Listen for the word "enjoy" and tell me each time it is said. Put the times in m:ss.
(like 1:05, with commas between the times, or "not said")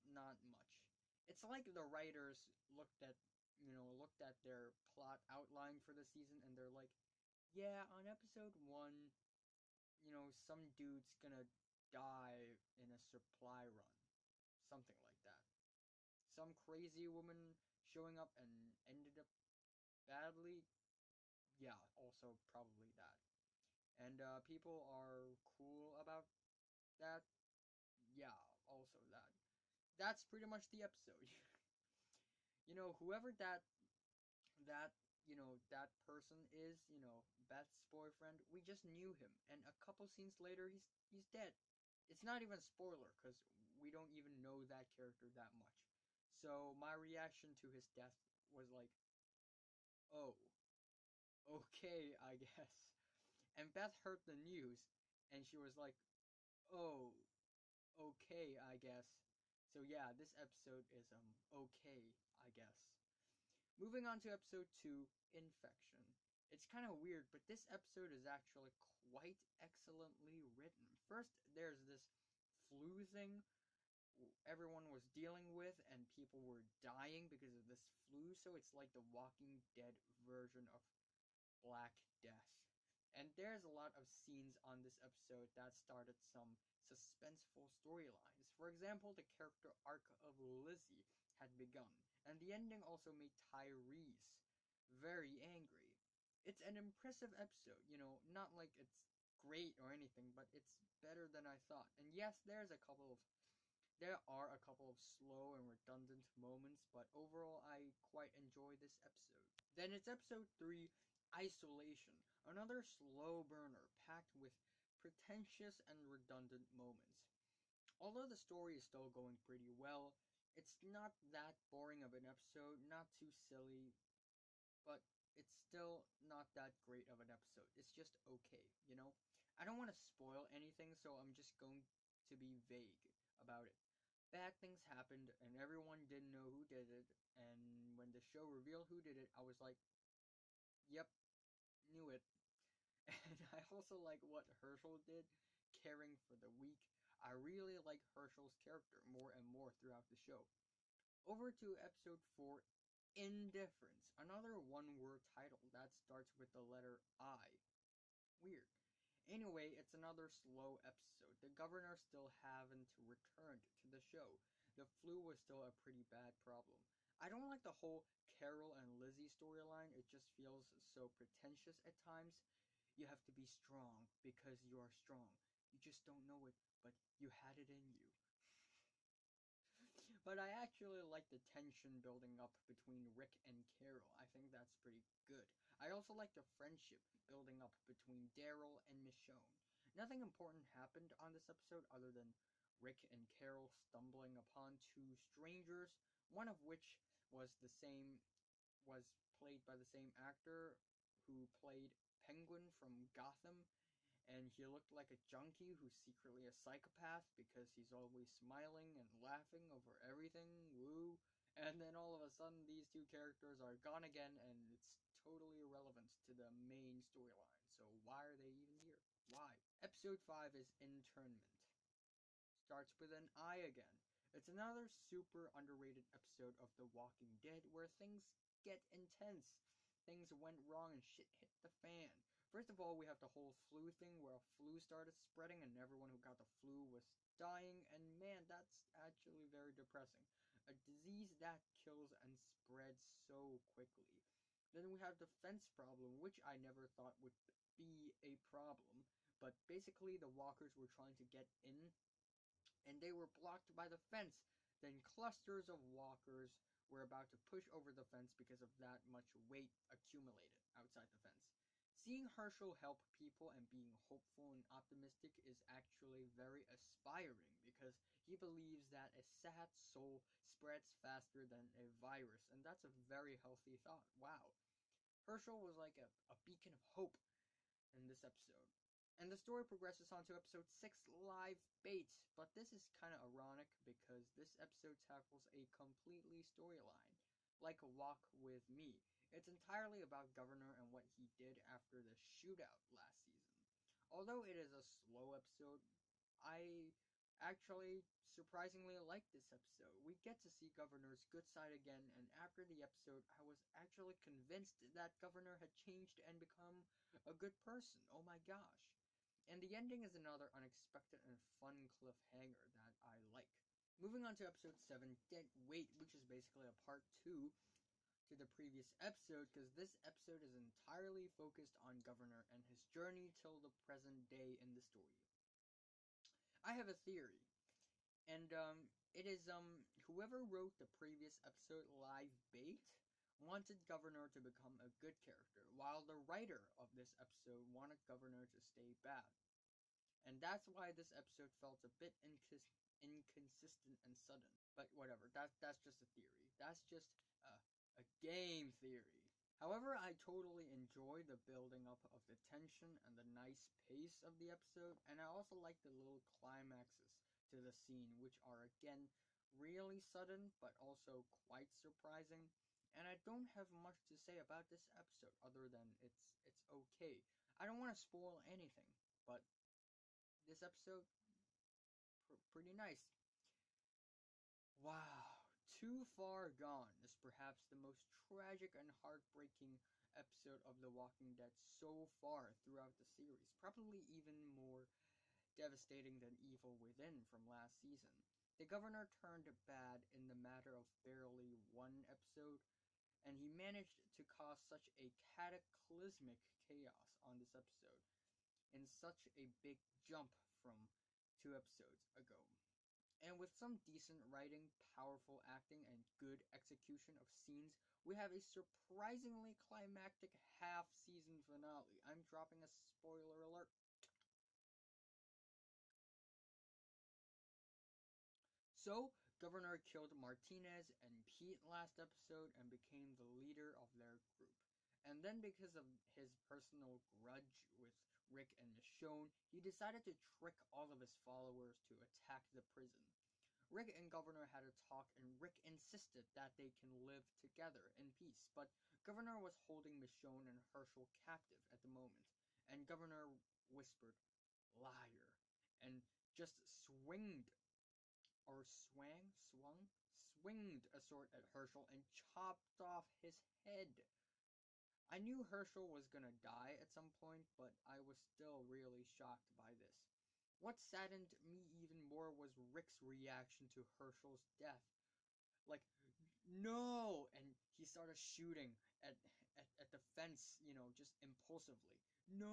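1:48, 5:50.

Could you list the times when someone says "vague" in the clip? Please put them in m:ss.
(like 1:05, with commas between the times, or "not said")
2:12.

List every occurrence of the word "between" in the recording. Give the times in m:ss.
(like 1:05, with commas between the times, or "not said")
3:02, 3:07.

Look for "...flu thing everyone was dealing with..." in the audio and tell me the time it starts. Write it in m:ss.
1:12.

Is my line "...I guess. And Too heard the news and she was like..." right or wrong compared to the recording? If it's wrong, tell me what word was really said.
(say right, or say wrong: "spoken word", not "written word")
wrong: "Beth", not "Too".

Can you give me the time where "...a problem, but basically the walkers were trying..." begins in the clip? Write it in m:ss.
4:08.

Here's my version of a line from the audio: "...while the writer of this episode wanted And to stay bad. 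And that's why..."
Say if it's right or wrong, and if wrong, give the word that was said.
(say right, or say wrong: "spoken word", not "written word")
wrong: "Governor", not "And".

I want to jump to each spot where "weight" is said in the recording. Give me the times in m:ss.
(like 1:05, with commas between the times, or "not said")
4:19, 5:15.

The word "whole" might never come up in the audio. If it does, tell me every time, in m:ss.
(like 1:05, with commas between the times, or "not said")
2:47, 3:53.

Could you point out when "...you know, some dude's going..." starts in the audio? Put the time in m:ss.
0:09.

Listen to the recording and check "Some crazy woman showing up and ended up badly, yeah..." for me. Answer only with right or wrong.
right.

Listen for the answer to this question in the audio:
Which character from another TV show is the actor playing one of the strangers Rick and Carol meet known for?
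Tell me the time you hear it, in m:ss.
3:22.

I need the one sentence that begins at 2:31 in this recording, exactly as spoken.
Over to episode 4 Indifference, another one word title that starts with the letter I.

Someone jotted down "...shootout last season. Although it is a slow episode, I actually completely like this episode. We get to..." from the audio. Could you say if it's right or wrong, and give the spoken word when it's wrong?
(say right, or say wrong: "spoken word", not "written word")
wrong: "surprisingly", not "completely".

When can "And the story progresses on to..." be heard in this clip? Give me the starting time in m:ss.
4:39.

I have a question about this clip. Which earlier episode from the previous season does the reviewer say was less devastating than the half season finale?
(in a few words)
Evil Within.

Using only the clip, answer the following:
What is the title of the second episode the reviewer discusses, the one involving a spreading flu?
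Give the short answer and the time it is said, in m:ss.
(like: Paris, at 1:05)
Infection, at 1:05.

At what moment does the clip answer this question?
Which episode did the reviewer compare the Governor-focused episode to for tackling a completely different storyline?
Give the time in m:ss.
4:47.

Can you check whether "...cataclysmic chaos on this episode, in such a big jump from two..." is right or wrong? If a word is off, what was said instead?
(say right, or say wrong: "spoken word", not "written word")
right.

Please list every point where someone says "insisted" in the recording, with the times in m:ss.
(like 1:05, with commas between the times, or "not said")
7:15.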